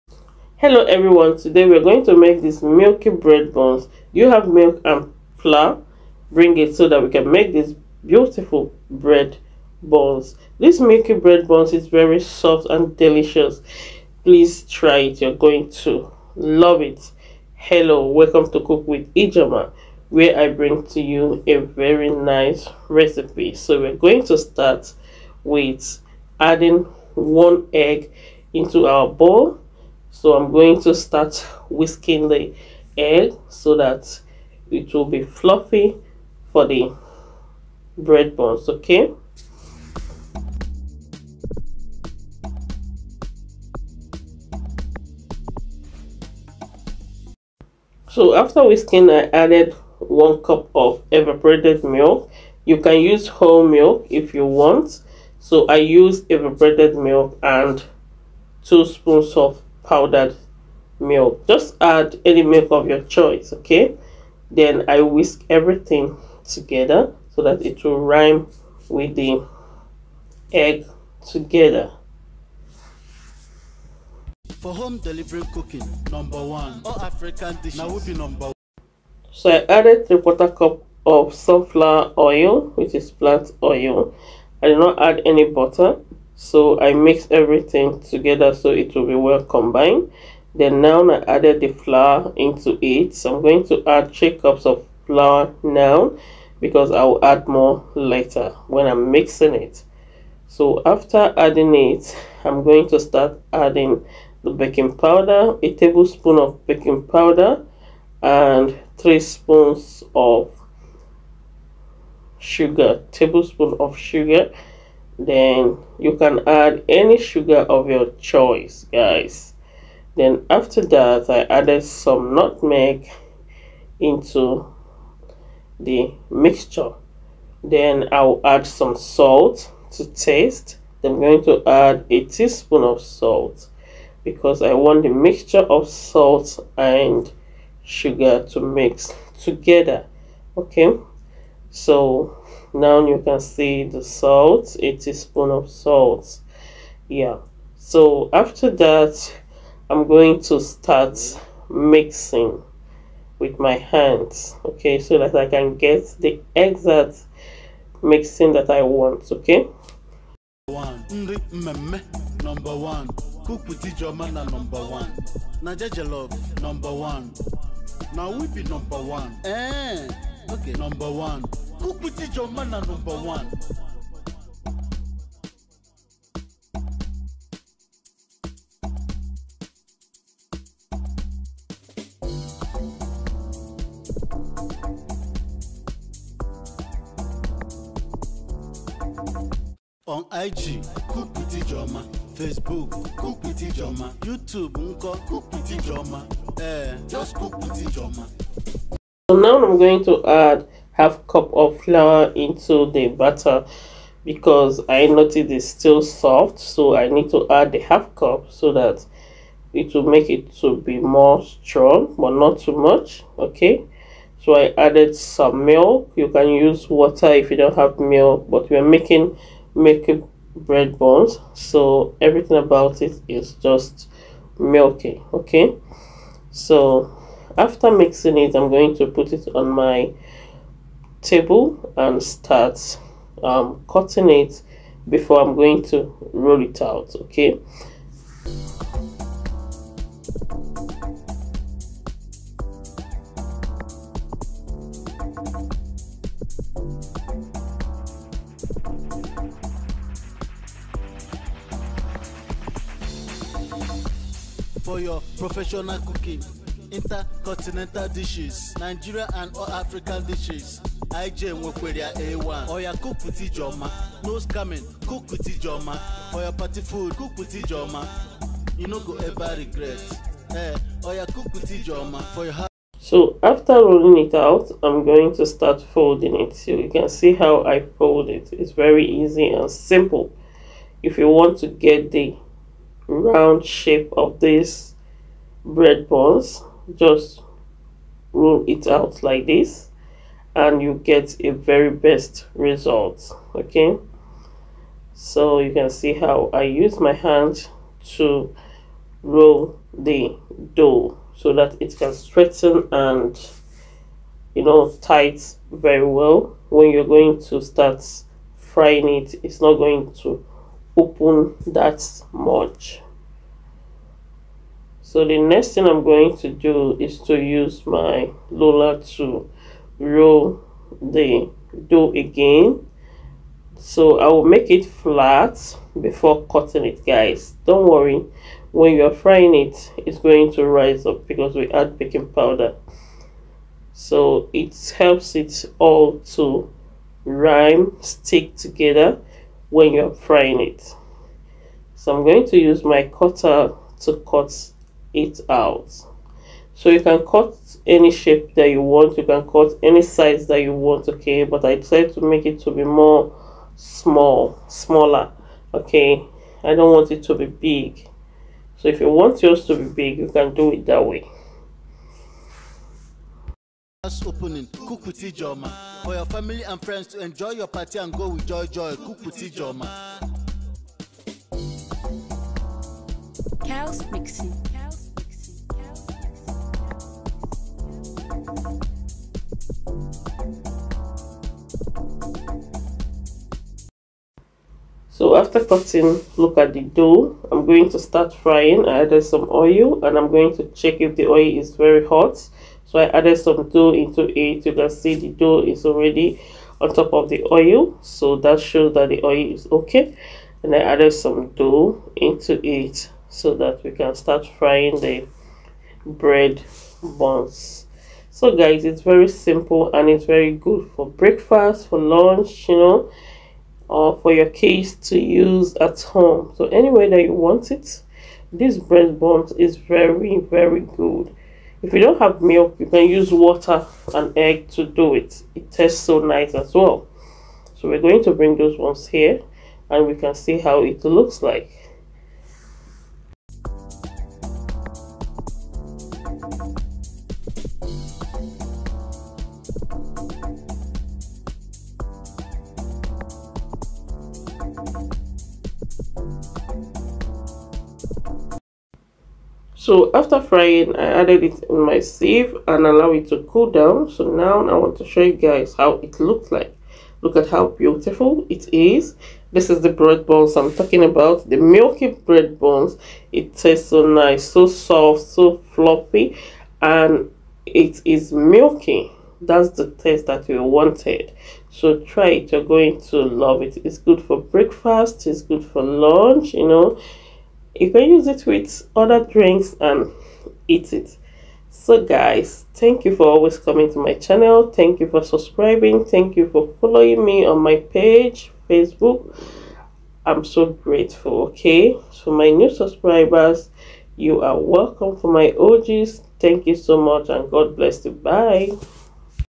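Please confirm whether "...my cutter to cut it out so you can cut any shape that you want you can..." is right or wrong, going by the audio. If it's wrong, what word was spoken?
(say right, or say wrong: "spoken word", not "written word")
right.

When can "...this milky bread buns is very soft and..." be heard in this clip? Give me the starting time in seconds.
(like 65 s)
10 s.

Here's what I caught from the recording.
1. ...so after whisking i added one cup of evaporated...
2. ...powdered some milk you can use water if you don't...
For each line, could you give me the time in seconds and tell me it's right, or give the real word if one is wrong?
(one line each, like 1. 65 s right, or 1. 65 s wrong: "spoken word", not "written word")
1. 48 s right
2. 214 s wrong: "added", not "powdered".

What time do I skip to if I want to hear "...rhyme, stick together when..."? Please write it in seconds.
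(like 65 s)
337 s.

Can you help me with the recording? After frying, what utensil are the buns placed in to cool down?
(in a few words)
Sieve.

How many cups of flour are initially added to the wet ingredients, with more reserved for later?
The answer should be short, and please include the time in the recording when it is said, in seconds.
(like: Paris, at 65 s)
3 cups, at 94 s.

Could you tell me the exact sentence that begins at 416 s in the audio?
So anyway that you want it, this breast bond is very, very good.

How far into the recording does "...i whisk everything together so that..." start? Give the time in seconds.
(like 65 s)
64 s.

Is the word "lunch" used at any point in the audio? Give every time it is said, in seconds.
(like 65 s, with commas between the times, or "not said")
411 s, 475 s.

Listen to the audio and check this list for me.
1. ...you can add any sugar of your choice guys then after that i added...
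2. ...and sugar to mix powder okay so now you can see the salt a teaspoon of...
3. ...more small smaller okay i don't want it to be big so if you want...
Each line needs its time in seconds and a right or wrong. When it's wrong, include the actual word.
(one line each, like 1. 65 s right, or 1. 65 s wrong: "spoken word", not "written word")
1. 115 s right
2. 136 s wrong: "together", not "powder"
3. 352 s right.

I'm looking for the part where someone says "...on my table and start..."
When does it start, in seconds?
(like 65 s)
229 s.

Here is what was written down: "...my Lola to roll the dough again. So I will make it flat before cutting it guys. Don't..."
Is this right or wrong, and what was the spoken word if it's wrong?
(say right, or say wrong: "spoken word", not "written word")
right.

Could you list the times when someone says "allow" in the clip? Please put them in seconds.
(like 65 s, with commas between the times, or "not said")
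452 s.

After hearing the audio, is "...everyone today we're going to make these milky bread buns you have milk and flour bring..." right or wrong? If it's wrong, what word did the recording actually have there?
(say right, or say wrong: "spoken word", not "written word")
right.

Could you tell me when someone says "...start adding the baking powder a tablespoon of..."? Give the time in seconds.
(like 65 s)
102 s.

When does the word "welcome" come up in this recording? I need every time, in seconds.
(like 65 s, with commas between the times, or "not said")
18 s, 494 s.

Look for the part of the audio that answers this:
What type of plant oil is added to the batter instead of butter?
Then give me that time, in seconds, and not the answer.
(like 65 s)
81 s.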